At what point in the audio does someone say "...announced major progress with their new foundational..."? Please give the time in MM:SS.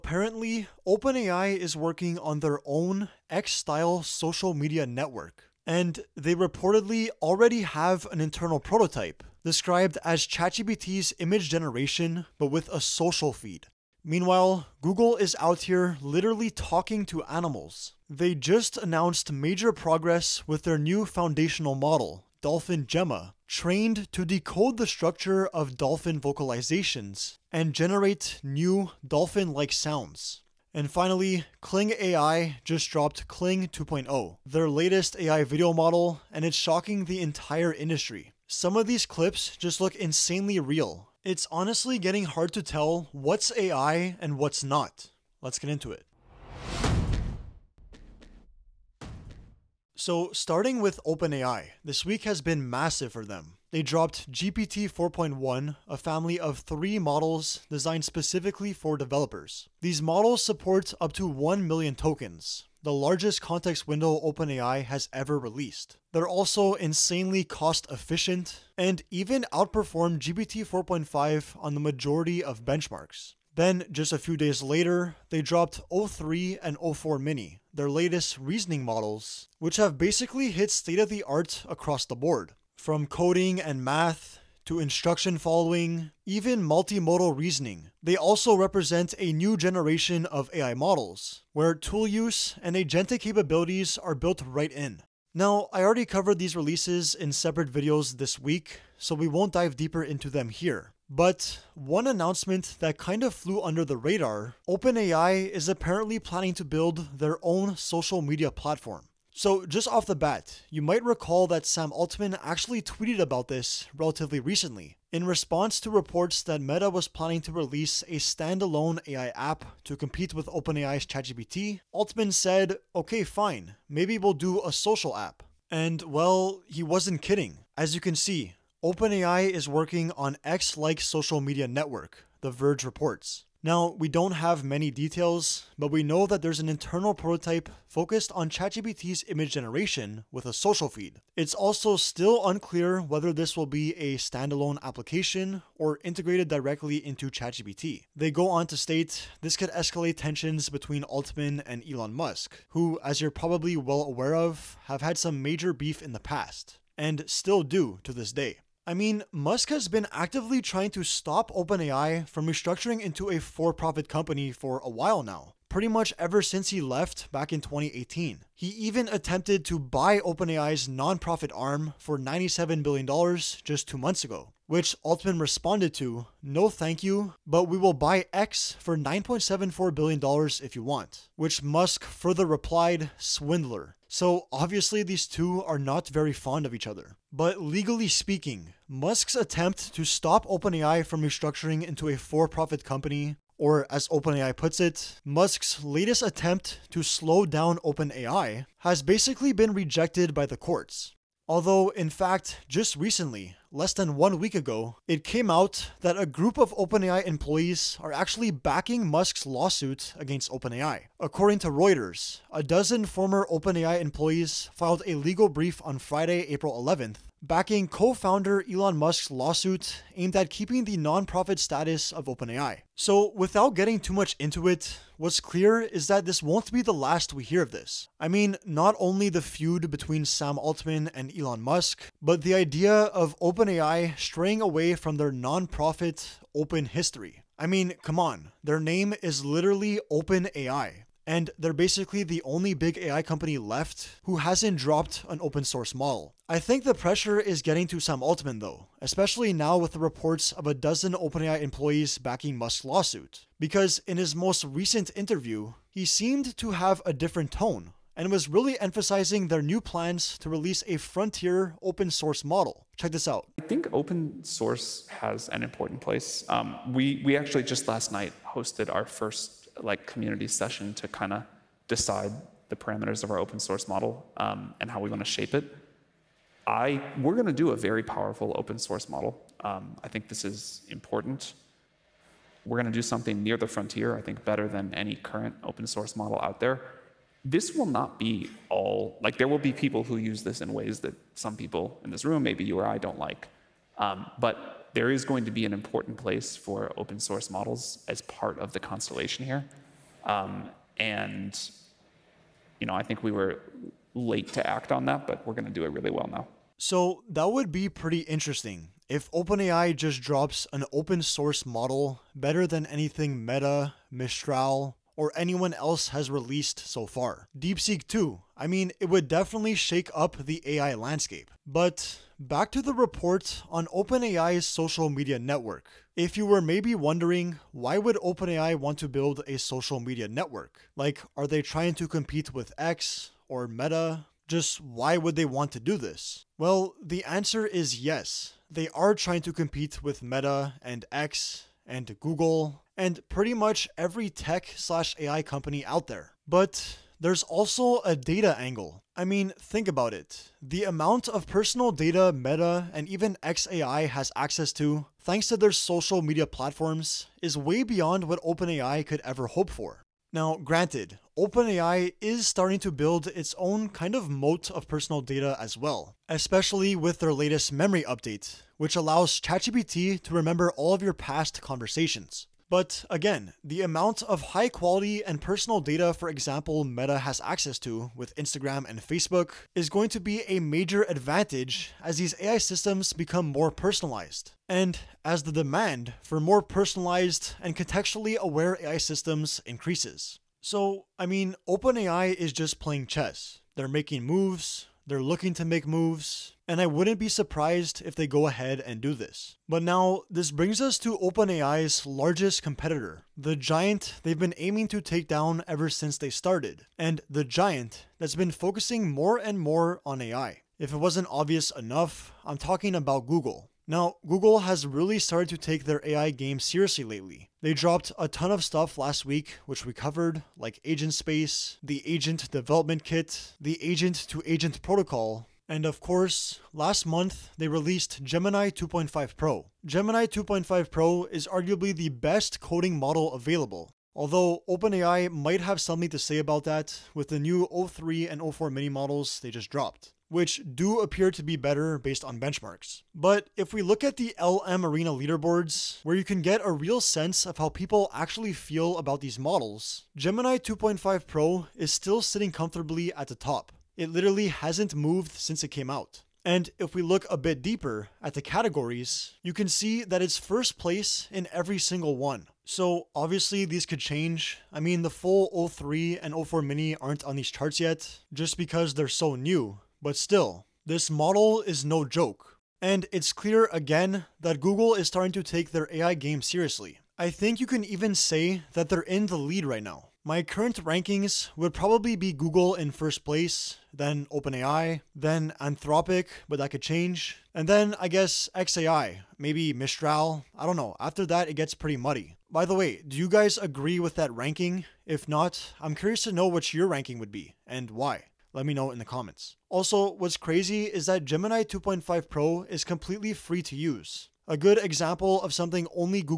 00:18.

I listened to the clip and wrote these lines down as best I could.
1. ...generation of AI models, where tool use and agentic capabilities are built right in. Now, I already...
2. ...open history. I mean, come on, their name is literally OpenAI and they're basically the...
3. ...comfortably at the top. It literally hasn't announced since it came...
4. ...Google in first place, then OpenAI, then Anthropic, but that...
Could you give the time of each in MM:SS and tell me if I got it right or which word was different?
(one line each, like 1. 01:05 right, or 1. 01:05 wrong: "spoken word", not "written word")
1. 01:29 right
2. 03:56 right
3. 07:32 wrong: "moved", not "announced"
4. 08:02 right.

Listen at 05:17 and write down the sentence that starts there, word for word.
DeepSeek 2, I mean, it would definitely shake up the AI landscape.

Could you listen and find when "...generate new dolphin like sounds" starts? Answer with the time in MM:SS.
00:27.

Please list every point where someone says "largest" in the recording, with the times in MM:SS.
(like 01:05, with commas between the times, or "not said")
01:02, 06:42.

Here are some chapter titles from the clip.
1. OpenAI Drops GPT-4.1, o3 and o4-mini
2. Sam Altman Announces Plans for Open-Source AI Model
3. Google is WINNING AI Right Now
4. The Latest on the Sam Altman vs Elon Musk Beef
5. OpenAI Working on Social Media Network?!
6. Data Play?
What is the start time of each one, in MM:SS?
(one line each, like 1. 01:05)
1. 00:50
2. 04:06
3. 06:39
4. 02:38
5. 01:41
6. 05:21.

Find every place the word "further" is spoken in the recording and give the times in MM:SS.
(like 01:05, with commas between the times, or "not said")
03:02.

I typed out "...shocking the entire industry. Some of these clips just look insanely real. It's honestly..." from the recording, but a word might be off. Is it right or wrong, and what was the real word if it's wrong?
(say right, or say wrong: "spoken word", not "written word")
right.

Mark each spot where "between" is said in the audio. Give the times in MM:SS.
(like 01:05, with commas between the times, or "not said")
02:30, 03:49.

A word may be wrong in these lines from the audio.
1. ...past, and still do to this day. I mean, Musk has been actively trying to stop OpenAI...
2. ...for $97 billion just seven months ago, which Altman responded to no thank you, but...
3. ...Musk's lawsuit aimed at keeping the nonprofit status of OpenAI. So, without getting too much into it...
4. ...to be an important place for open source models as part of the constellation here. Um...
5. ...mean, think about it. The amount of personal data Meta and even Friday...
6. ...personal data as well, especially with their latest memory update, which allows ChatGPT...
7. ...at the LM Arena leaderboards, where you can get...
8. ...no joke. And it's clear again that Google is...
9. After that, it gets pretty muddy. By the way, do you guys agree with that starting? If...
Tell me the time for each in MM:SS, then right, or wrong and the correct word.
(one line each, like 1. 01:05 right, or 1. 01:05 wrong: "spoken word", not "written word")
1. 02:36 right
2. 02:51 wrong: "two", not "seven"
3. 03:38 right
4. 04:55 right
5. 05:49 wrong: "XAI", not "Friday"
6. 06:04 right
7. 07:24 right
8. 07:51 right
9. 08:11 wrong: "ranking", not "starting".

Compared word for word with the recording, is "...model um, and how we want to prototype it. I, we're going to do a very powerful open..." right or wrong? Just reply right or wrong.
wrong.